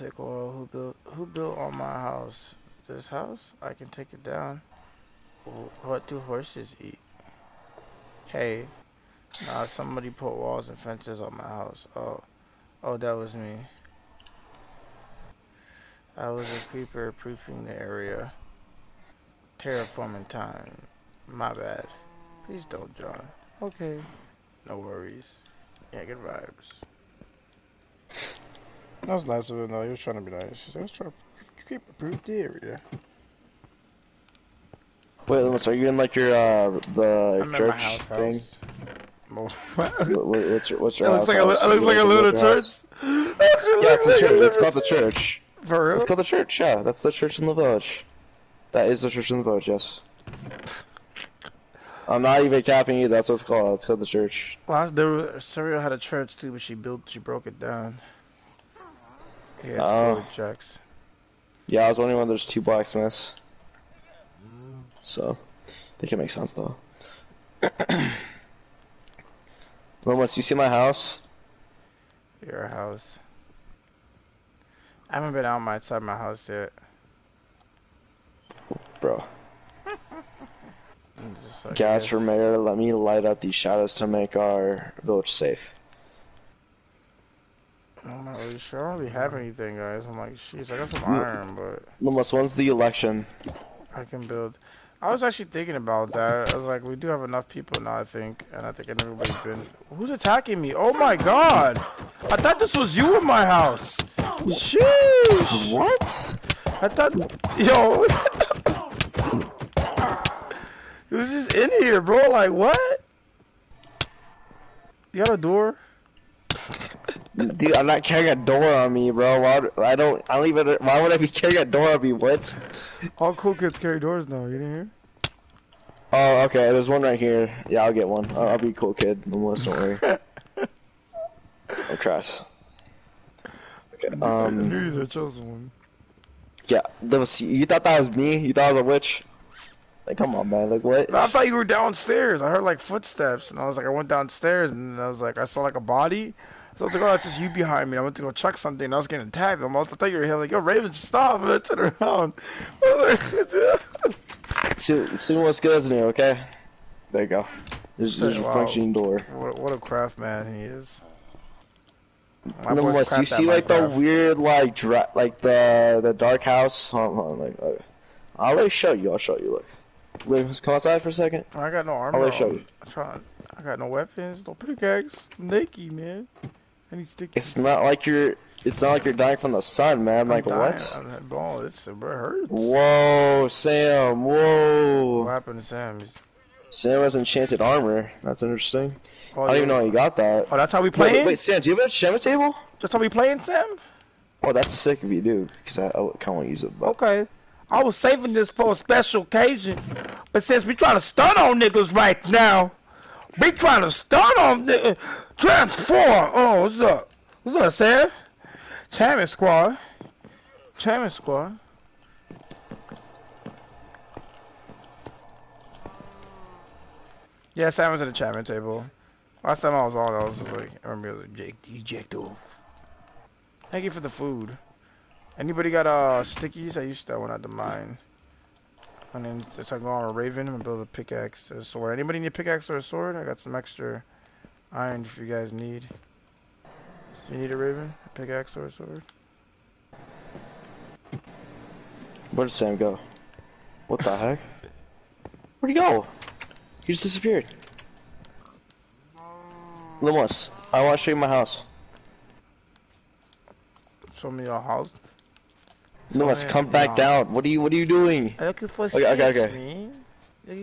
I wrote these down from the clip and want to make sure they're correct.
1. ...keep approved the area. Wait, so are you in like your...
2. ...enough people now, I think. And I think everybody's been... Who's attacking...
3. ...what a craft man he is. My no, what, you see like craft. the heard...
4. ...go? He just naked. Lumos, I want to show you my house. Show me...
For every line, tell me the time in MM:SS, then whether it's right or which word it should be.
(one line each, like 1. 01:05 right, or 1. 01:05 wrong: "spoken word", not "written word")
1. 00:31 right
2. 01:37 right
3. 02:39 wrong: "weird", not "heard"
4. 04:05 wrong: "disappeared", not "naked".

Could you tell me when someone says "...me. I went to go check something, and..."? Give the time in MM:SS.
02:27.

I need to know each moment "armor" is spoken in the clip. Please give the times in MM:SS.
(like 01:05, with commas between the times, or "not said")
02:51, 03:07.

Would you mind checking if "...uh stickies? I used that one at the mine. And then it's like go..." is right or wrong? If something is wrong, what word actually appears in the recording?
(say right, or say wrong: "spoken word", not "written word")
right.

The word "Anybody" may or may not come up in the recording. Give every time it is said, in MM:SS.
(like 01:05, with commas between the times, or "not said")
03:45, 03:51.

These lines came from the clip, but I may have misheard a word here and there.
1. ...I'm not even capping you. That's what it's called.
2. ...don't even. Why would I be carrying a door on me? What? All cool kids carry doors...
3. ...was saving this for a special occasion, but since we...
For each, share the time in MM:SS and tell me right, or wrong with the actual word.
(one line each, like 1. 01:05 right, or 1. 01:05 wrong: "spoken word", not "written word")
1. 00:52 right
2. 02:00 right
3. 03:17 right.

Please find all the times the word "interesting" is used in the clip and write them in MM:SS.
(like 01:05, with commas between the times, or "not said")
03:08.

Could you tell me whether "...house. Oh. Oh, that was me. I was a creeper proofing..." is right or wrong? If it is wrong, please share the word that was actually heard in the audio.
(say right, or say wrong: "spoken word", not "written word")
right.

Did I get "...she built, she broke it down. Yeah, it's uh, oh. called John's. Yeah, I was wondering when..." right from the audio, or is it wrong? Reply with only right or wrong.
wrong.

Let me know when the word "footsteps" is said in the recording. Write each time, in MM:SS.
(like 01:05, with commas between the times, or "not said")
02:22.